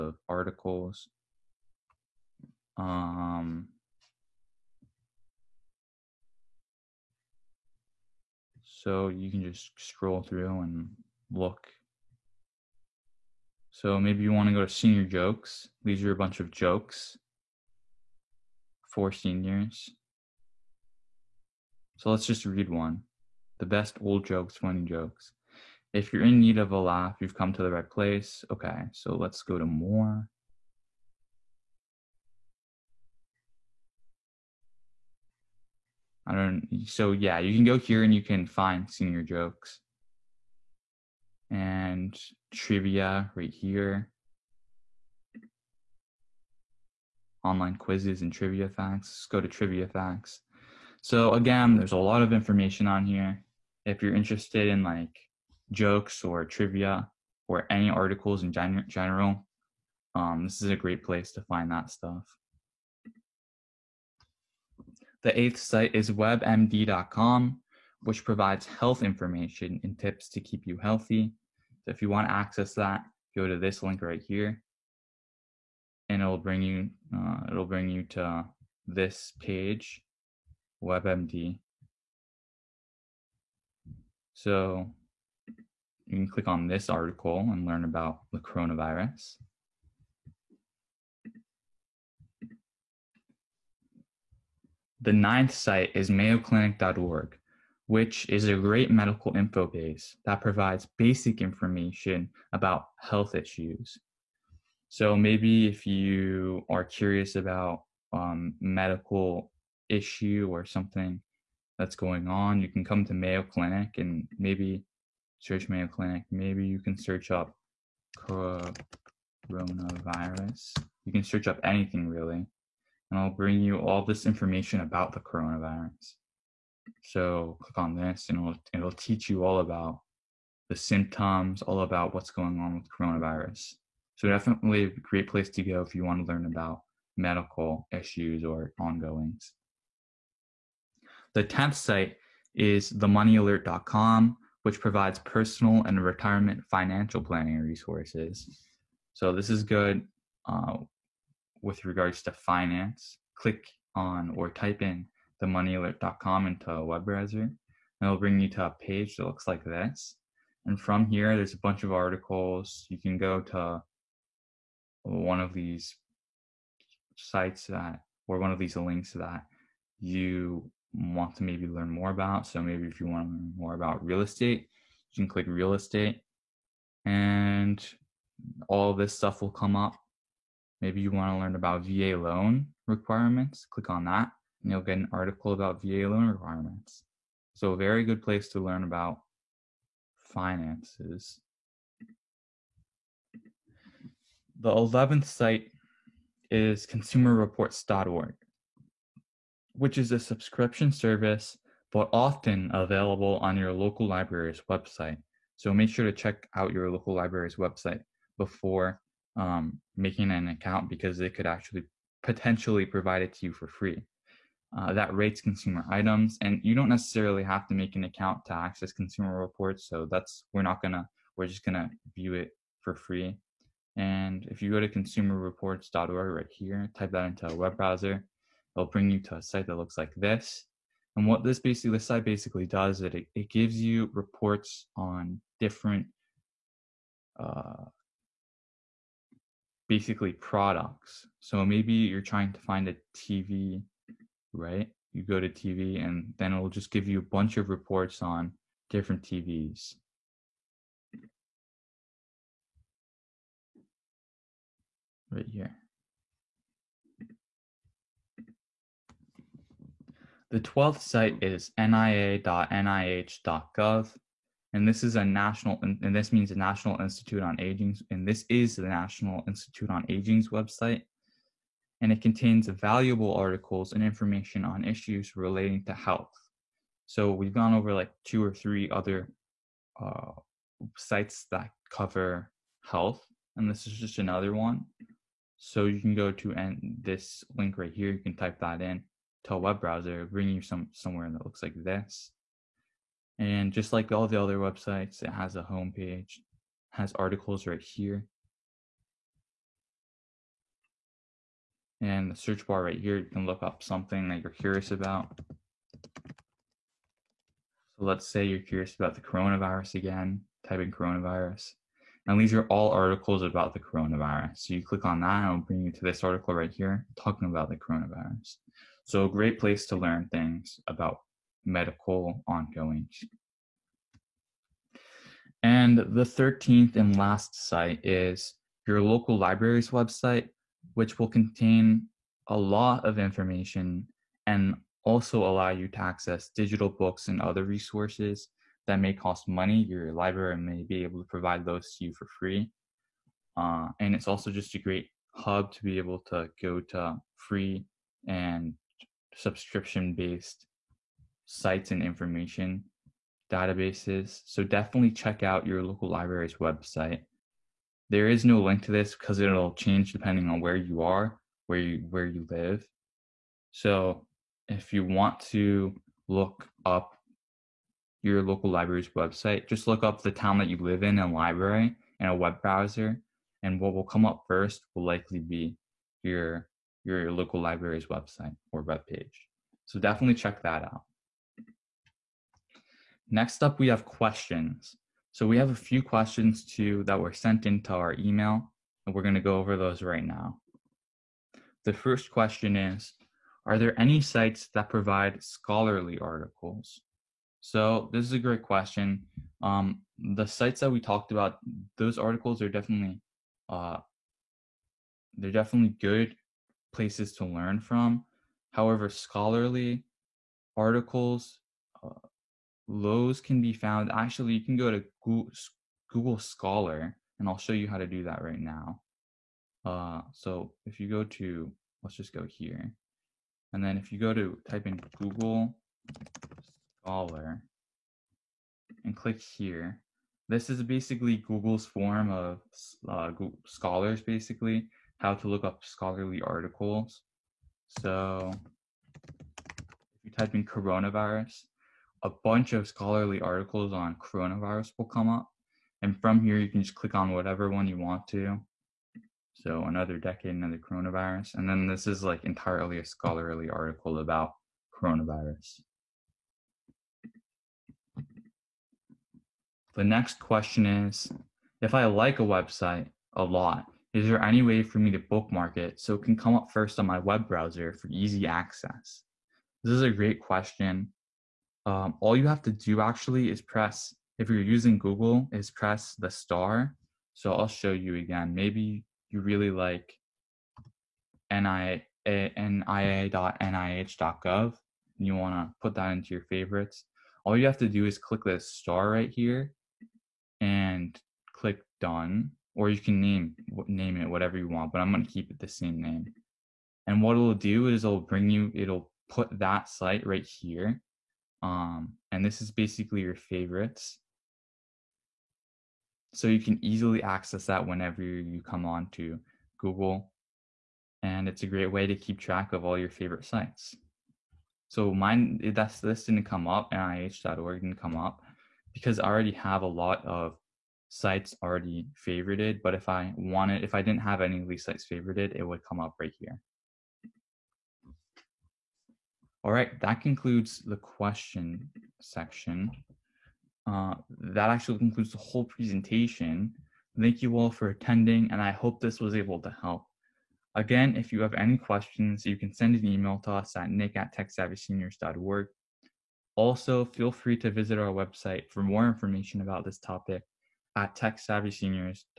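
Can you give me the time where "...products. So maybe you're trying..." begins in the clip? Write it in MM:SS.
04:00.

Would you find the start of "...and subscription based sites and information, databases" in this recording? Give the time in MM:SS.
05:48.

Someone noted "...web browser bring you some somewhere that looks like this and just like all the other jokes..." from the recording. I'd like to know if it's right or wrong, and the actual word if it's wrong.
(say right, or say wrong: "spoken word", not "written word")
wrong: "websites", not "jokes".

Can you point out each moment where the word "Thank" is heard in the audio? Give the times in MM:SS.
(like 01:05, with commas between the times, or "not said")
08:57.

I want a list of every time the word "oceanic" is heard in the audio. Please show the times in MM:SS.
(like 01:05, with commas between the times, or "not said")
not said.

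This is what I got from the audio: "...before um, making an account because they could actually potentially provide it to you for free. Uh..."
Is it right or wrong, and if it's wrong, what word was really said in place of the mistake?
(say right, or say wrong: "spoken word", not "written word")
right.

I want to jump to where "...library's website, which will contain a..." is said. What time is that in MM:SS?
05:29.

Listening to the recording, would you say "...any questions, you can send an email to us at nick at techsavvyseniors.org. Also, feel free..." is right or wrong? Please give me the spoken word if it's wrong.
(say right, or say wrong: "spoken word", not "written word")
right.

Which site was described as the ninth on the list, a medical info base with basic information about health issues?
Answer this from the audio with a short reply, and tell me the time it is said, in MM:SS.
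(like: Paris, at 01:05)
mayoclinic.org, at 01:36.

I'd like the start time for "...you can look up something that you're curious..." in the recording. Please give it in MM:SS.
05:03.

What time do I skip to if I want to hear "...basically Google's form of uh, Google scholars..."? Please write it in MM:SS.
07:10.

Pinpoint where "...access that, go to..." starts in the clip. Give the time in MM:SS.
01:12.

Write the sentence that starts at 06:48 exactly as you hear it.
However, scholarly articles, uh, Lowe's can be found.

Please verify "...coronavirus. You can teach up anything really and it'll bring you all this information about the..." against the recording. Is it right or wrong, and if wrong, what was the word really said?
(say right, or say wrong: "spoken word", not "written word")
wrong: "search", not "teach".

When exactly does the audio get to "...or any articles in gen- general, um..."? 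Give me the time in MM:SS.
00:57.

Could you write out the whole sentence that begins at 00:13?
So maybe you want to go to senior jokes.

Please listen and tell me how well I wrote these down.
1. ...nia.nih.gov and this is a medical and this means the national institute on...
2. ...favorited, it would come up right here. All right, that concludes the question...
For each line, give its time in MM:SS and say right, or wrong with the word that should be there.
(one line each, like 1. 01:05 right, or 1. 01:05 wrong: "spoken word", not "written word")
1. 04:21 wrong: "national", not "medical"
2. 08:45 right.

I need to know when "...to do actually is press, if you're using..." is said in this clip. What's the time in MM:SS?
07:52.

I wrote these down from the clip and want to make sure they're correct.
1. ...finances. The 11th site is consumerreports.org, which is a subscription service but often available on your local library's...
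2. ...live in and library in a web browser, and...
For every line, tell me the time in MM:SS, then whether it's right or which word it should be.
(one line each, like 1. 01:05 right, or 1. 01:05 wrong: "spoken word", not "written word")
1. 03:10 right
2. 06:10 right.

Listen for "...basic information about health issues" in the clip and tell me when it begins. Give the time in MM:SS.
01:40.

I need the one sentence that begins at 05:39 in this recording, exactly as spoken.
Your library may be able to provide those to you for free.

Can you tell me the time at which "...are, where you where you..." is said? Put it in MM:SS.
06:01.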